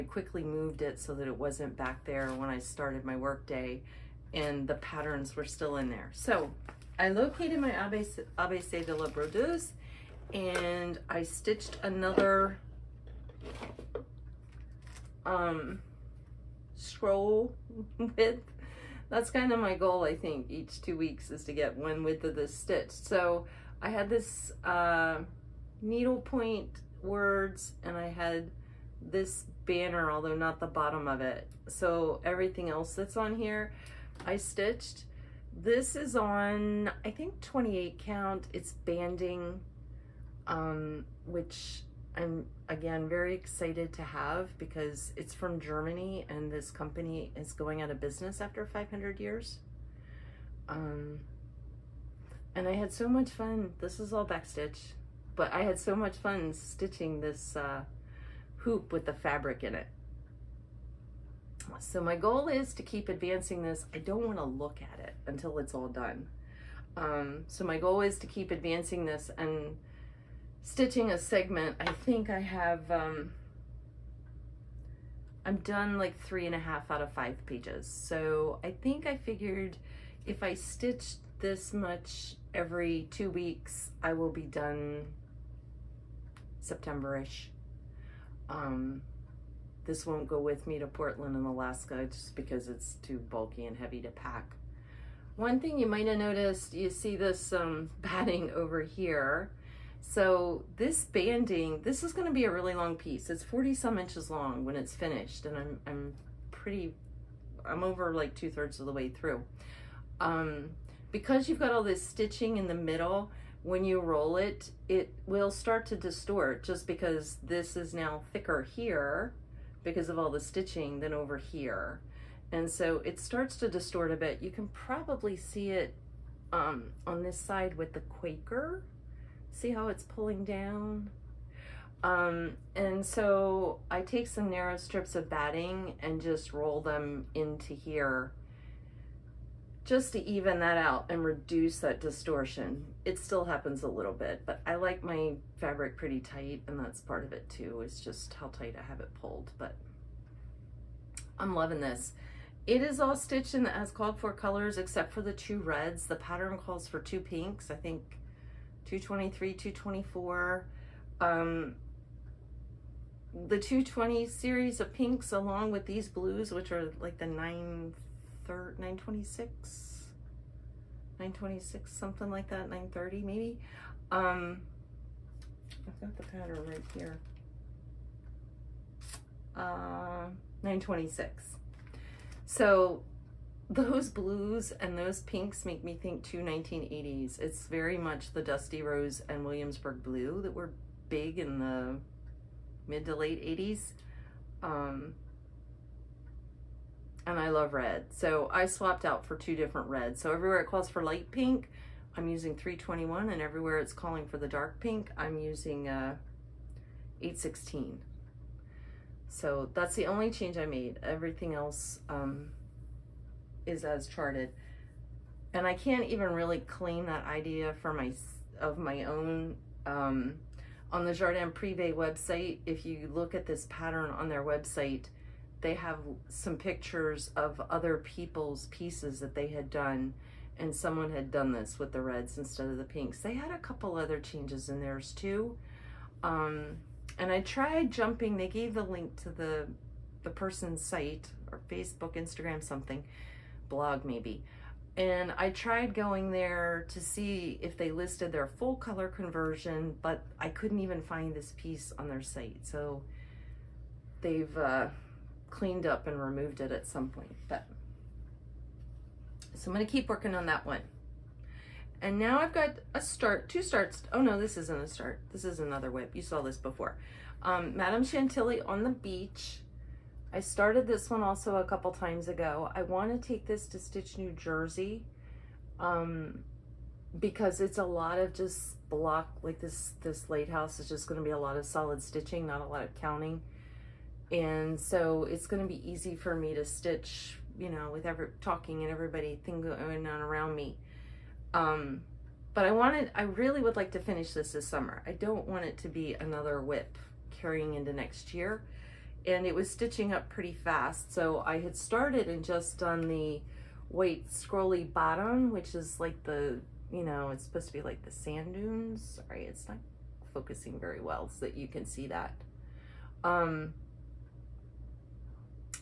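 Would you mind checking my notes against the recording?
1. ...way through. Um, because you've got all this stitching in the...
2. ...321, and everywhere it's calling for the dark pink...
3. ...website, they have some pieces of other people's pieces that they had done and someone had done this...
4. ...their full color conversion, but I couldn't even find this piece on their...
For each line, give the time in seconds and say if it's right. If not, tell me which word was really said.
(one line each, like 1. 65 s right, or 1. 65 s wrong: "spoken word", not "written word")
1. 108 s right
2. 202 s right
3. 224 s wrong: "pictures", not "pieces"
4. 248 s right.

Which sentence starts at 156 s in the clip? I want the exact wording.
The pattern calls for two pinks.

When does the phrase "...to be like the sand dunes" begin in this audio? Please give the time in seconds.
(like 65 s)
307 s.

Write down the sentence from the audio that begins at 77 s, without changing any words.
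So I think I figured if I stitch this much every two weeks, I will be done September-ish.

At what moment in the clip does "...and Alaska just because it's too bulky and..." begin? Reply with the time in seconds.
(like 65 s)
91 s.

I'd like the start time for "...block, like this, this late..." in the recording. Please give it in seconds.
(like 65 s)
278 s.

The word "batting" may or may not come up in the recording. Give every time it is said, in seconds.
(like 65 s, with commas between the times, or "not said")
98 s, 135 s.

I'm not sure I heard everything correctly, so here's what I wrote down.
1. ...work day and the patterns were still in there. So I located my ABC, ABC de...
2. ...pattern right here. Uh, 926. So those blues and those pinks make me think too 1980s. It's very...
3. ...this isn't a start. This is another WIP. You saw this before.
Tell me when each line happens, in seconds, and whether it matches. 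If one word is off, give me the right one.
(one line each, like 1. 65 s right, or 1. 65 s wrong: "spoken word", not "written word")
1. 3 s right
2. 176 s right
3. 264 s right.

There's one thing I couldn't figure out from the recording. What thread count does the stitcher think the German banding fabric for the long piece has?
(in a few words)
28.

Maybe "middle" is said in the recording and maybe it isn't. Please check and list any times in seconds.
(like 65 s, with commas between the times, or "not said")
112 s.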